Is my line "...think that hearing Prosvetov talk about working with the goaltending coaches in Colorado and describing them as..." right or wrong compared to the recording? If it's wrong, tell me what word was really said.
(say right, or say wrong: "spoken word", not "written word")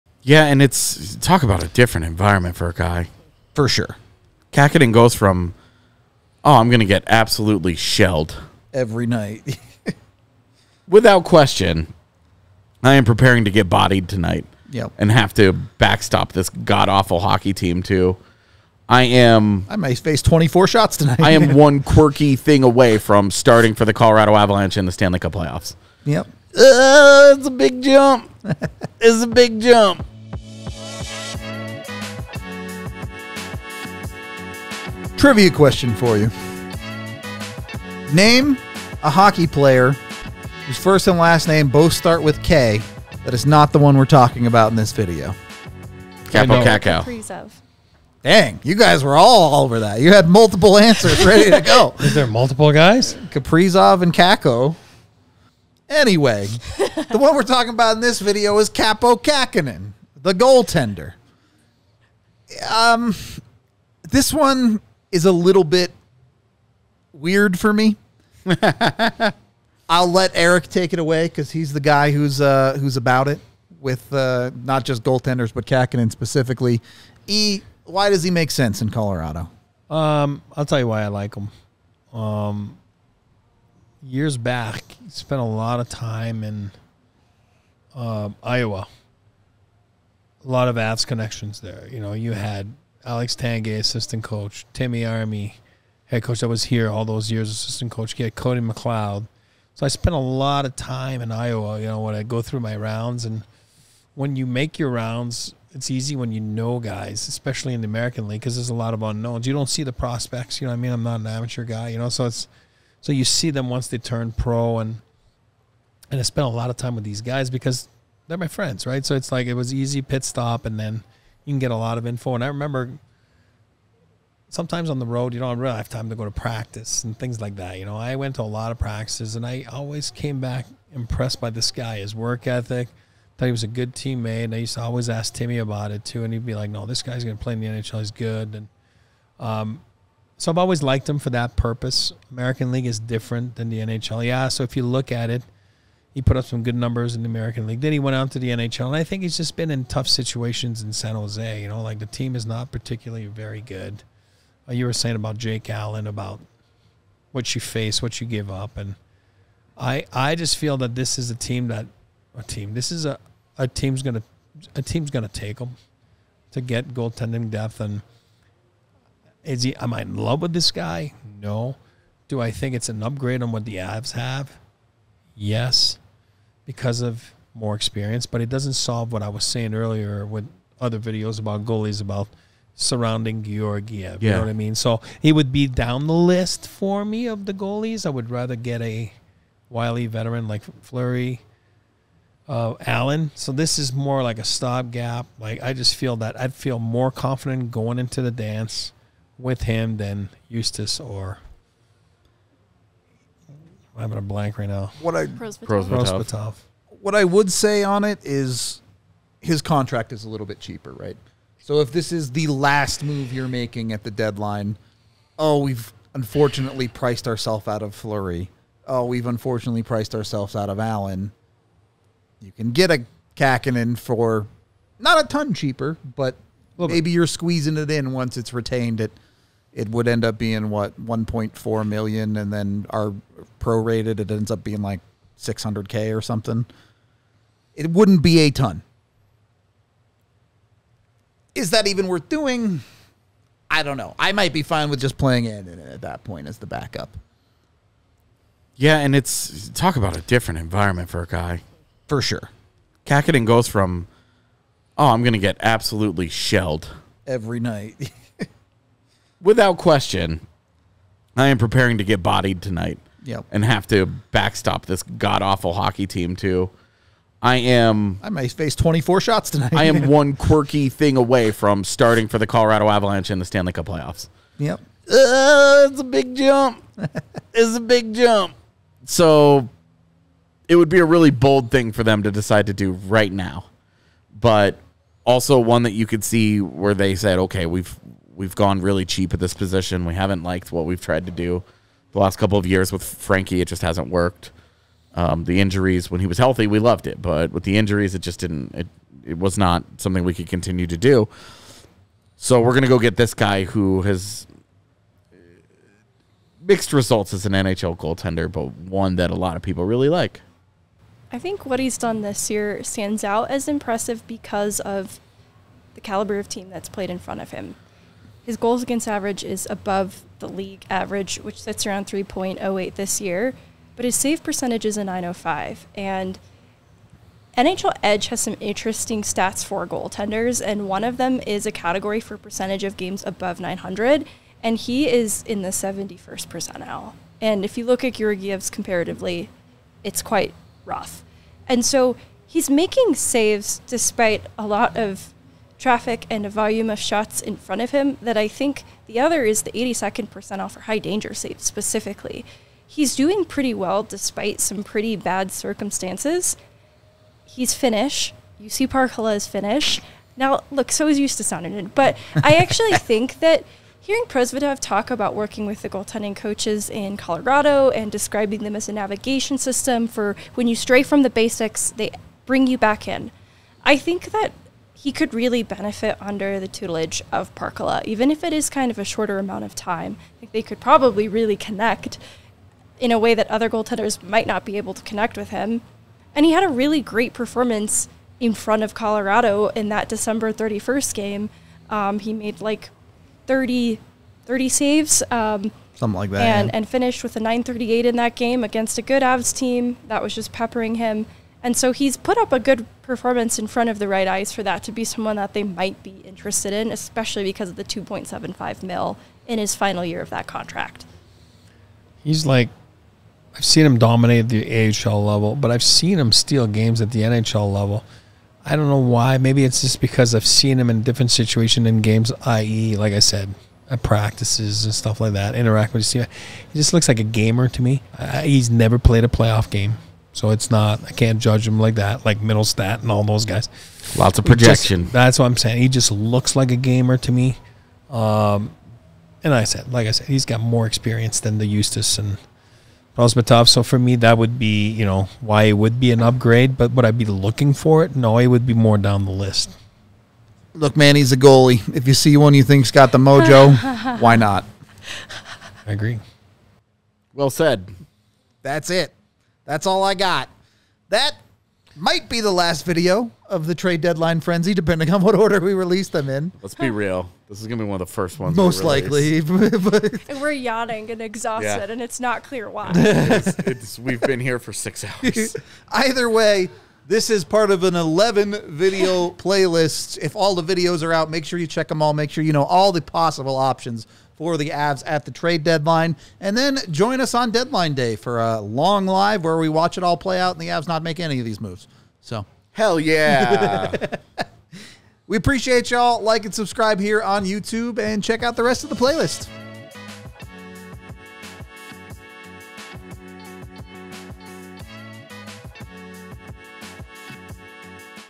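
right.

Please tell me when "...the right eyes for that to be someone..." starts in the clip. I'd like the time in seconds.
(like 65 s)
403 s.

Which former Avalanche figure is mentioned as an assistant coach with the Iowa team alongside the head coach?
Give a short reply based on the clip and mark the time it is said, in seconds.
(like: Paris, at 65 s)
Alex Tanguay, at 93 s.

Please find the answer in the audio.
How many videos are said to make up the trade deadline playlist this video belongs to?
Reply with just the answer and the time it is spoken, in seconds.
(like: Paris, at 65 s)
11, at 477 s.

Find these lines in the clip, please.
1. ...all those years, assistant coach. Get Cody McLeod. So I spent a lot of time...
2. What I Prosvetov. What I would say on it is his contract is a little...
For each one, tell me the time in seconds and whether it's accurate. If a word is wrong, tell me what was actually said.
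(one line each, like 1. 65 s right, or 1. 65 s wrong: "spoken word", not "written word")
1. 96 s right
2. 205 s right.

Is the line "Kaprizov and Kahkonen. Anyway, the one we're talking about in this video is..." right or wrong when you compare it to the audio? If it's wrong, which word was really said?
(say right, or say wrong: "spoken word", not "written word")
wrong: "Kakko", not "Kahkonen".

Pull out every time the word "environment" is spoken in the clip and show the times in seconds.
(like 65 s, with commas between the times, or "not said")
2 s, 250 s.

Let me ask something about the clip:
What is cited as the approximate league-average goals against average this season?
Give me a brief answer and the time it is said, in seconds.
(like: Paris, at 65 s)
3.08, at 322 s.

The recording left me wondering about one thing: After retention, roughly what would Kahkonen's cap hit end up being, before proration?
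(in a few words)
1.4 million.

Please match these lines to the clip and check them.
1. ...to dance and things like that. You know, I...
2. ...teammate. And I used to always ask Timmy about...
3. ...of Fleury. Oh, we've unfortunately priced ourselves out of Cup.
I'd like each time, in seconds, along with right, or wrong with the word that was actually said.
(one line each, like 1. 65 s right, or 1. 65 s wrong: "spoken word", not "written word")
1. 126 s wrong: "practice", not "dance"
2. 133 s right
3. 217 s wrong: "Allen", not "Cup".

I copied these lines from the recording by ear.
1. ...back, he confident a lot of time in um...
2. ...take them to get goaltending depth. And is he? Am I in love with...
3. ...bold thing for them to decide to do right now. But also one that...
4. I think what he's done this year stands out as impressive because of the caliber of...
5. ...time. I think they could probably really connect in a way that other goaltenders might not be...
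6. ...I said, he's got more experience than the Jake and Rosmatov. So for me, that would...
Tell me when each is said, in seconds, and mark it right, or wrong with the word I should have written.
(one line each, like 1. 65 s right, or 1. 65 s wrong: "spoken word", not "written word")
1. 84 s wrong: "spent", not "confident"
2. 165 s right
3. 281 s right
4. 311 s right
5. 379 s right
6. 440 s wrong: "Justus", not "Jake".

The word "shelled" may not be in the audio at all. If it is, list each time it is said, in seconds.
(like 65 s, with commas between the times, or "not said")
7 s, 256 s.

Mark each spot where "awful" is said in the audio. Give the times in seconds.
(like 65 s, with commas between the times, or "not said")
16 s, 265 s.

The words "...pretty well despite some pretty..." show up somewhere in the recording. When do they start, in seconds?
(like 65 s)
353 s.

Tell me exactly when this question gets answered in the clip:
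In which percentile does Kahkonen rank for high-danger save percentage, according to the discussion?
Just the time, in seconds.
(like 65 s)
349 s.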